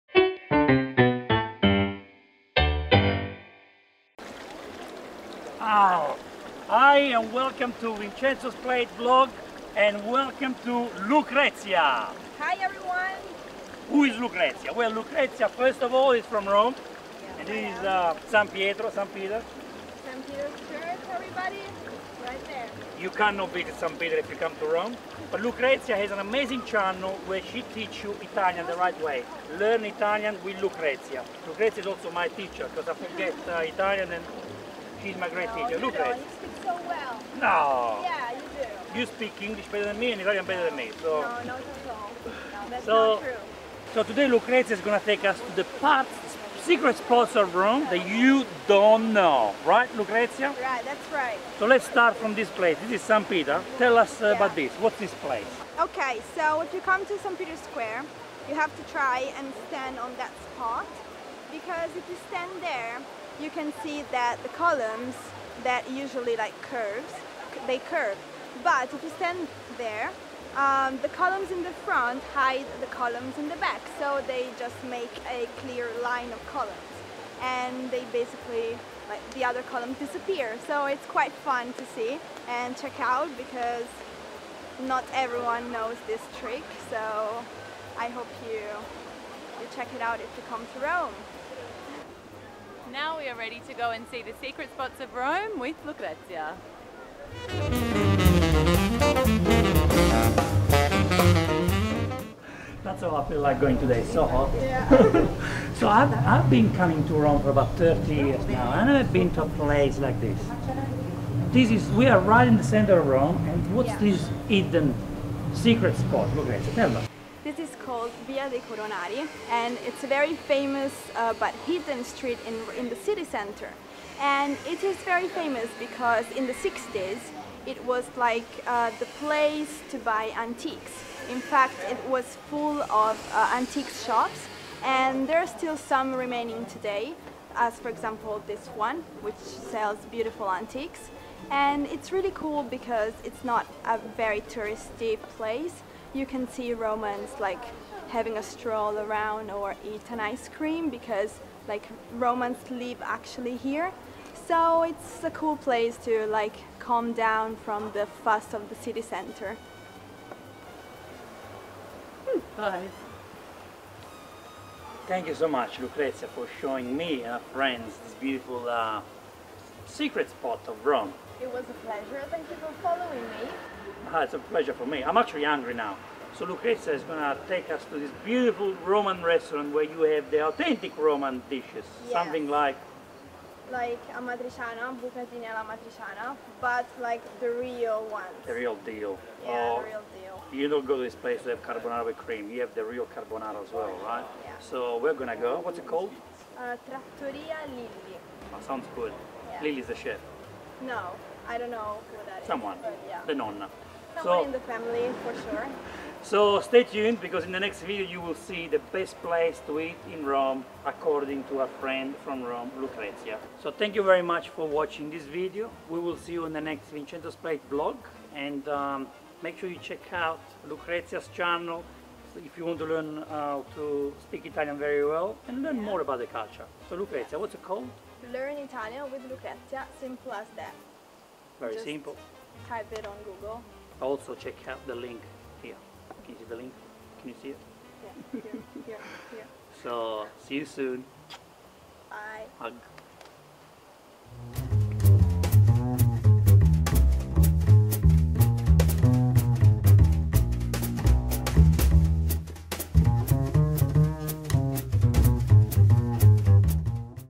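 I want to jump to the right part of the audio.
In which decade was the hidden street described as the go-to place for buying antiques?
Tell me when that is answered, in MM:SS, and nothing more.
02:06.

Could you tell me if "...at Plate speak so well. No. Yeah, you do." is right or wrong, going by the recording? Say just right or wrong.
wrong.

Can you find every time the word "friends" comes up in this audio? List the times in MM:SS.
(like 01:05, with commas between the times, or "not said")
02:47, 03:31.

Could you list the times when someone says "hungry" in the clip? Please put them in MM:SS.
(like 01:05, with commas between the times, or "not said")
02:55.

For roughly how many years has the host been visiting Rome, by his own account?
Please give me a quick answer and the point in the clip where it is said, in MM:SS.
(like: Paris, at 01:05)
30 years, at 01:47.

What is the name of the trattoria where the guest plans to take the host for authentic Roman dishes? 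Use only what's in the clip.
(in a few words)
Trattoria Lilli.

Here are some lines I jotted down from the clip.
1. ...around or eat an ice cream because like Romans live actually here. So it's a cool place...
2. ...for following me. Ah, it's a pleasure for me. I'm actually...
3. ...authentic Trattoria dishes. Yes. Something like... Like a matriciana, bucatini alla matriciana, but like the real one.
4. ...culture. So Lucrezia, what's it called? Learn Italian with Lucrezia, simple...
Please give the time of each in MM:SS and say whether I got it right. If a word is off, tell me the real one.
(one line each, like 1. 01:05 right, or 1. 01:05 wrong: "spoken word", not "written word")
1. 02:28 right
2. 02:52 right
3. 03:00 wrong: "Roman", not "Trattoria"
4. 03:46 right.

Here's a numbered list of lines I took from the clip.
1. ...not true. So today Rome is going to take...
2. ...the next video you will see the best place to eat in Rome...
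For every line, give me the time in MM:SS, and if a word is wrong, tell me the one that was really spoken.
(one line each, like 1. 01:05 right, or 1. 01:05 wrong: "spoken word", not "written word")
1. 00:43 wrong: "Lucrezia", not "Rome"
2. 03:27 right.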